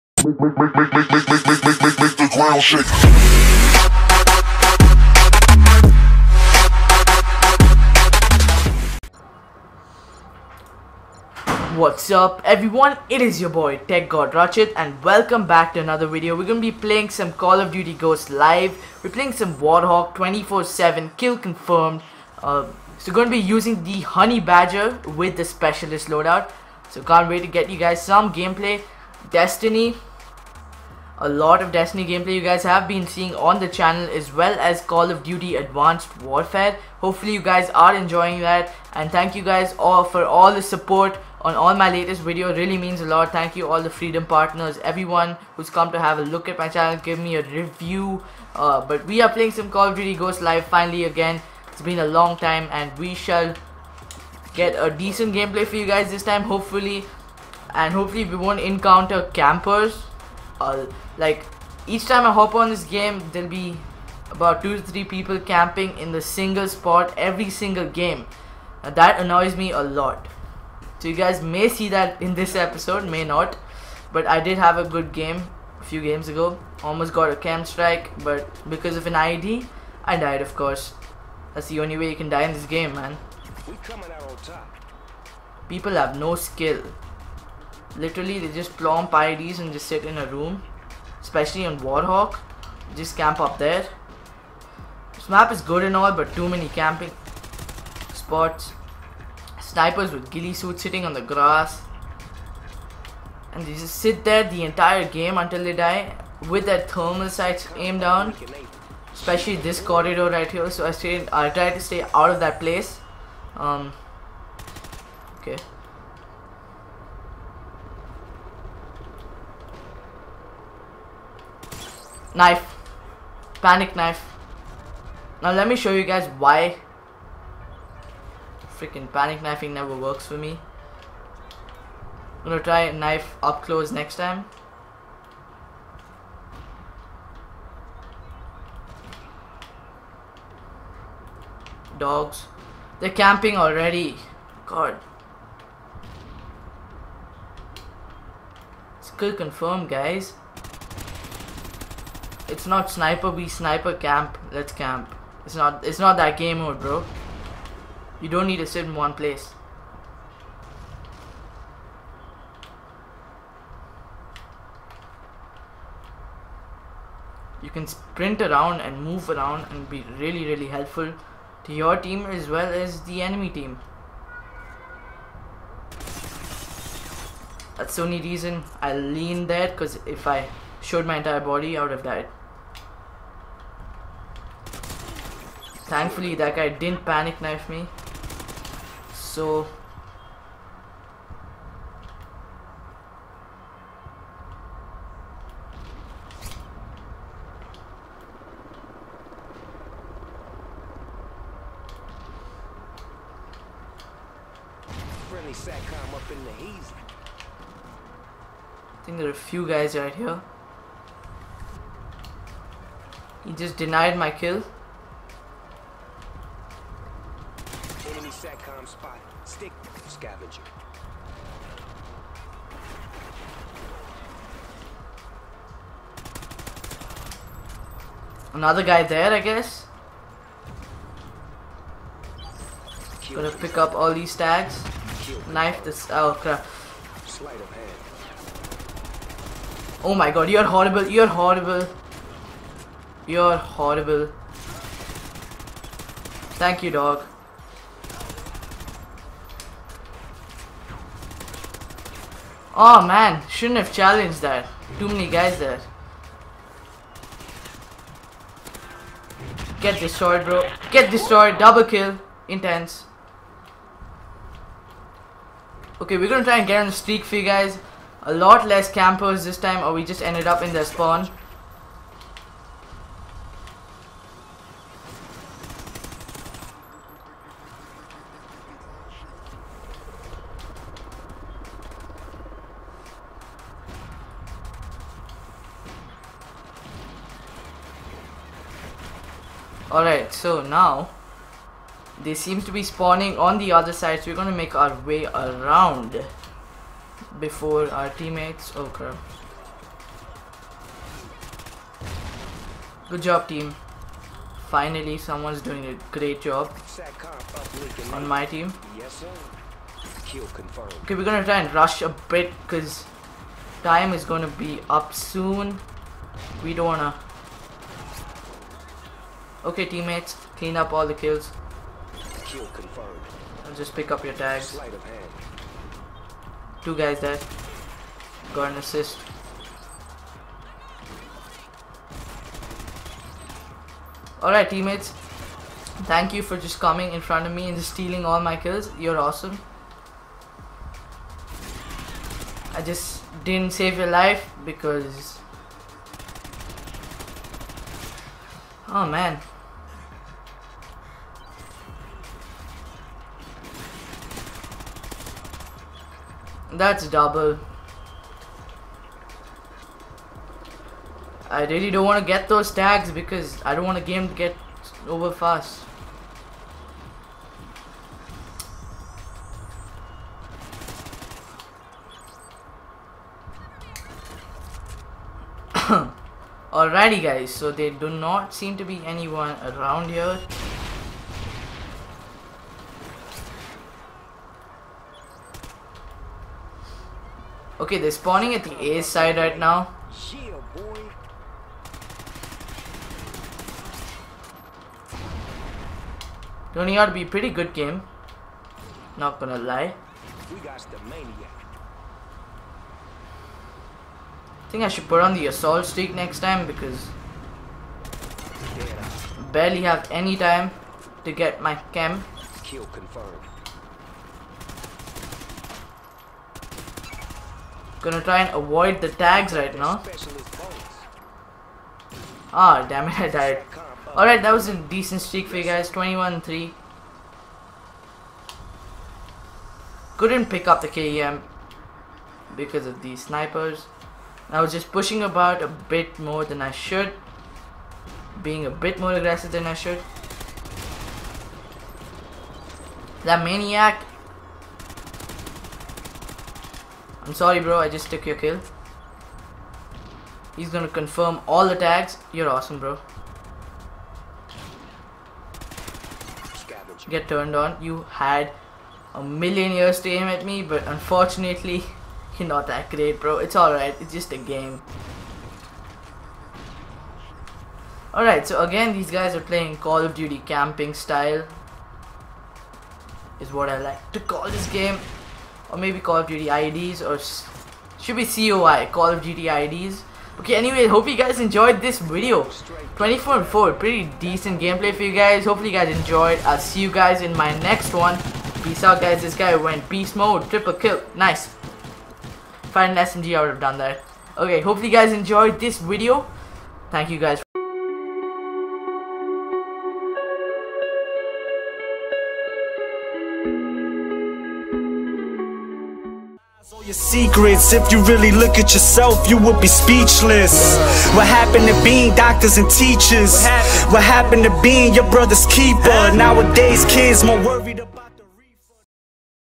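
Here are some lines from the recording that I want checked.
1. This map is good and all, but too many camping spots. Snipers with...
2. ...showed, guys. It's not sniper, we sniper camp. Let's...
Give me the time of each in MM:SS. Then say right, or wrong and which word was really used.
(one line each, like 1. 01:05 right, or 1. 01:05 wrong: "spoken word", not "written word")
1. 01:35 right
2. 02:29 wrong: "confirmed", not "showed".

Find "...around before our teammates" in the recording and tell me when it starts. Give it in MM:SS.
04:55.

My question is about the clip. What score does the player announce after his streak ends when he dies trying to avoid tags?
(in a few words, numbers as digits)
21-3.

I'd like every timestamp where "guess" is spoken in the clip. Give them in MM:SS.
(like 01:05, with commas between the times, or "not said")
03:49.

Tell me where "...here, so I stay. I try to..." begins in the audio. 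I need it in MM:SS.
01:50.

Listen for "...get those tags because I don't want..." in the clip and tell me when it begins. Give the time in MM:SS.
06:02.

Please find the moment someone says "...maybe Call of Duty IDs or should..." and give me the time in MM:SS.
07:55.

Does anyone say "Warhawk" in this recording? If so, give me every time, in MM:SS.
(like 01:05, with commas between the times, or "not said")
00:19, 01:31.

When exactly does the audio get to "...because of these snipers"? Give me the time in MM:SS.
07:12.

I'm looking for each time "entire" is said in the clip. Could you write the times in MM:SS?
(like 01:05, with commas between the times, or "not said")
01:44, 03:01.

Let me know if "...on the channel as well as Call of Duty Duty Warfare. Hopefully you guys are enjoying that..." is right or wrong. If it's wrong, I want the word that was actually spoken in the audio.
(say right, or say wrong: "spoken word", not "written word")
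wrong: "Advanced", not "Duty".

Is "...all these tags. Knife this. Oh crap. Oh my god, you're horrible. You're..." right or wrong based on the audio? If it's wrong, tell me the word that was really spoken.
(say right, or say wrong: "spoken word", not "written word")
right.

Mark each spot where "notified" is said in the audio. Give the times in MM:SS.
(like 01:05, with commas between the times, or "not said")
not said.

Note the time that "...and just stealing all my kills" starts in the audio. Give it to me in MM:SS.
05:37.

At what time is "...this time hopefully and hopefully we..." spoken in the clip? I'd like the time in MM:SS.
00:56.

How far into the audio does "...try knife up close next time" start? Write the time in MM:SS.
02:12.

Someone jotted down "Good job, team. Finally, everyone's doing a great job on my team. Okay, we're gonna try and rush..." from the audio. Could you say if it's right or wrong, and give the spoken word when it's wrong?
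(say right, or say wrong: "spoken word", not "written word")
wrong: "someone", not "everyone".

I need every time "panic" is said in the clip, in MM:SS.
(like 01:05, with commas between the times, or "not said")
02:03, 02:09, 03:07.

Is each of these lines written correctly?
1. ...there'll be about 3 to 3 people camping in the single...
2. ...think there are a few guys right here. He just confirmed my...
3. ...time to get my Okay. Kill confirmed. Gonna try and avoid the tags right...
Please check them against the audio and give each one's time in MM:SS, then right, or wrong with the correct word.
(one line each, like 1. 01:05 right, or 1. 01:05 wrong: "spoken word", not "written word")
1. 01:03 wrong: "2", not "3"
2. 03:29 wrong: "denied", not "confirmed"
3. 06:50 wrong: "KEM", not "Okay".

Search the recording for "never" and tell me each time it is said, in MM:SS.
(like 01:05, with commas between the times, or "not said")
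02:09.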